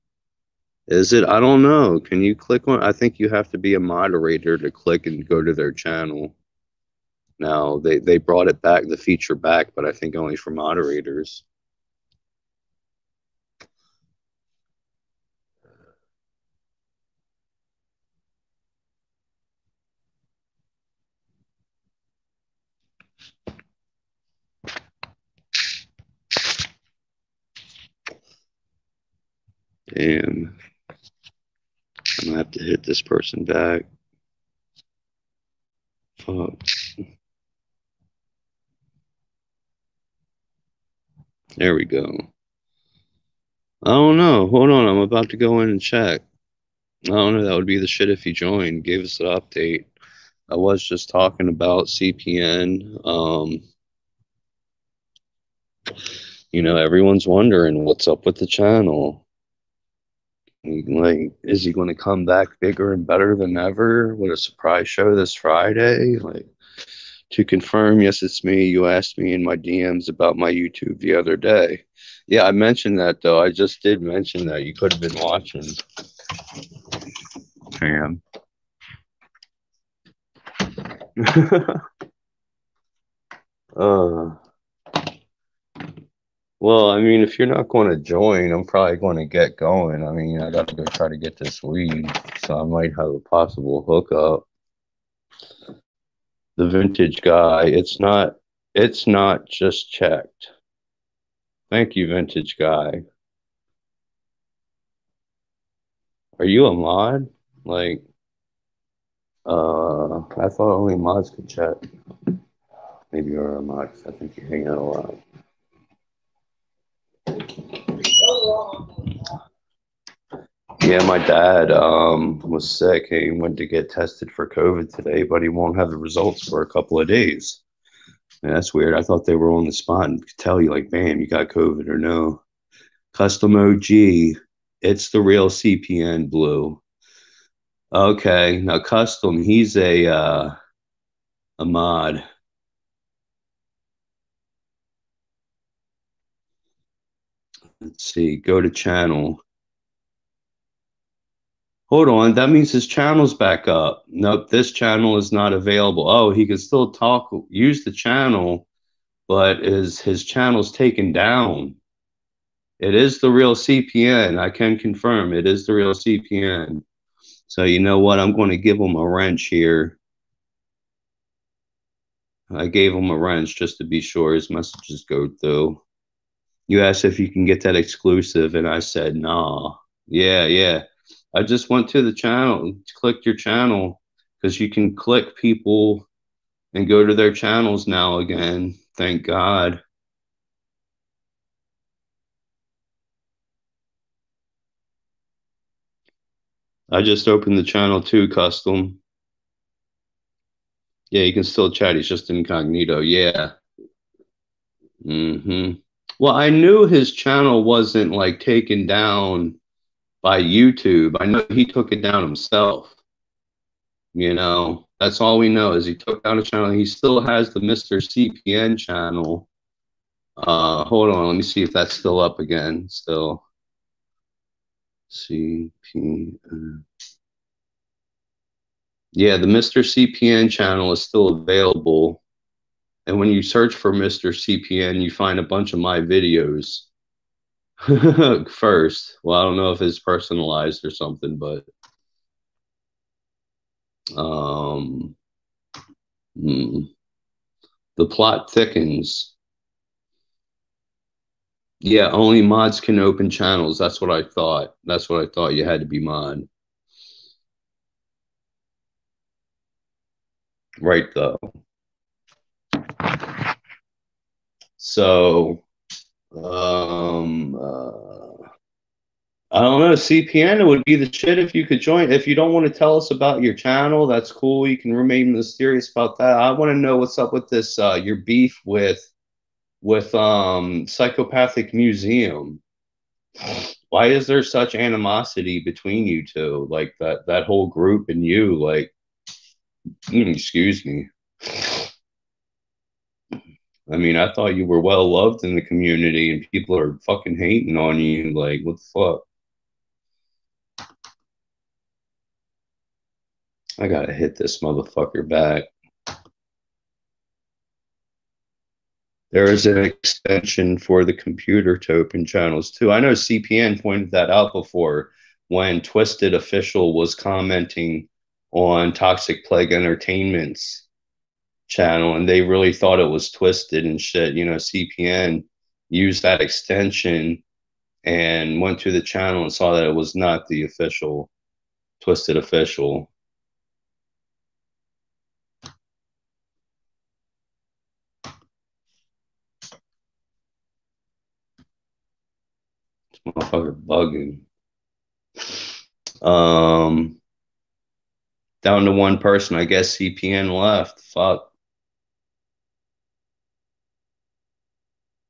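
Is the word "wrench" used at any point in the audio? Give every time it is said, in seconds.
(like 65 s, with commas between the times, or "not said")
169 s, 173 s.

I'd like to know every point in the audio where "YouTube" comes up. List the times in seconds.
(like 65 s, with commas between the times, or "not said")
70 s, 210 s.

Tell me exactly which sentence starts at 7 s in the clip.
They they brought it back, the feature back, but I think only for moderators.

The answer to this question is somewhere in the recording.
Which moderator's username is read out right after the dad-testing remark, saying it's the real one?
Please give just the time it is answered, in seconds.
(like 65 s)
133 s.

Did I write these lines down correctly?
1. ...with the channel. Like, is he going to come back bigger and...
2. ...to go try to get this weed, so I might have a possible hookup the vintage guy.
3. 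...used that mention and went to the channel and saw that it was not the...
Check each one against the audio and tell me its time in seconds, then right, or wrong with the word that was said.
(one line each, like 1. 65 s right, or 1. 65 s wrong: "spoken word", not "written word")
1. 58 s right
2. 90 s right
3. 325 s wrong: "extension", not "mention".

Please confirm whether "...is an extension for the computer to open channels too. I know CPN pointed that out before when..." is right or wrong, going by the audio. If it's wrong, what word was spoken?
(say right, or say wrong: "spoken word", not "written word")
right.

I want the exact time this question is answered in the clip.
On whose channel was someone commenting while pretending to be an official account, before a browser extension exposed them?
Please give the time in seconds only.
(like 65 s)
318 s.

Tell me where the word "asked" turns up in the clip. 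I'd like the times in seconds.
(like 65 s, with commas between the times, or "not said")
68 s, 176 s.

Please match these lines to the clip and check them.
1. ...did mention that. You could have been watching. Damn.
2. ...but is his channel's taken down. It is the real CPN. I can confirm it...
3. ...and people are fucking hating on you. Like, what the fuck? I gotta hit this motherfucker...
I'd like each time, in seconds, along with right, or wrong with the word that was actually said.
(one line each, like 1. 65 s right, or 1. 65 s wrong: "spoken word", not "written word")
1. 73 s right
2. 159 s right
3. 296 s right.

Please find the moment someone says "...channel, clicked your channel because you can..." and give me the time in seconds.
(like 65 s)
182 s.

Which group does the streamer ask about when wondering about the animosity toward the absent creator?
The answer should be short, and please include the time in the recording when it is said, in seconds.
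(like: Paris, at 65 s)
Psychopathic Museum, at 280 s.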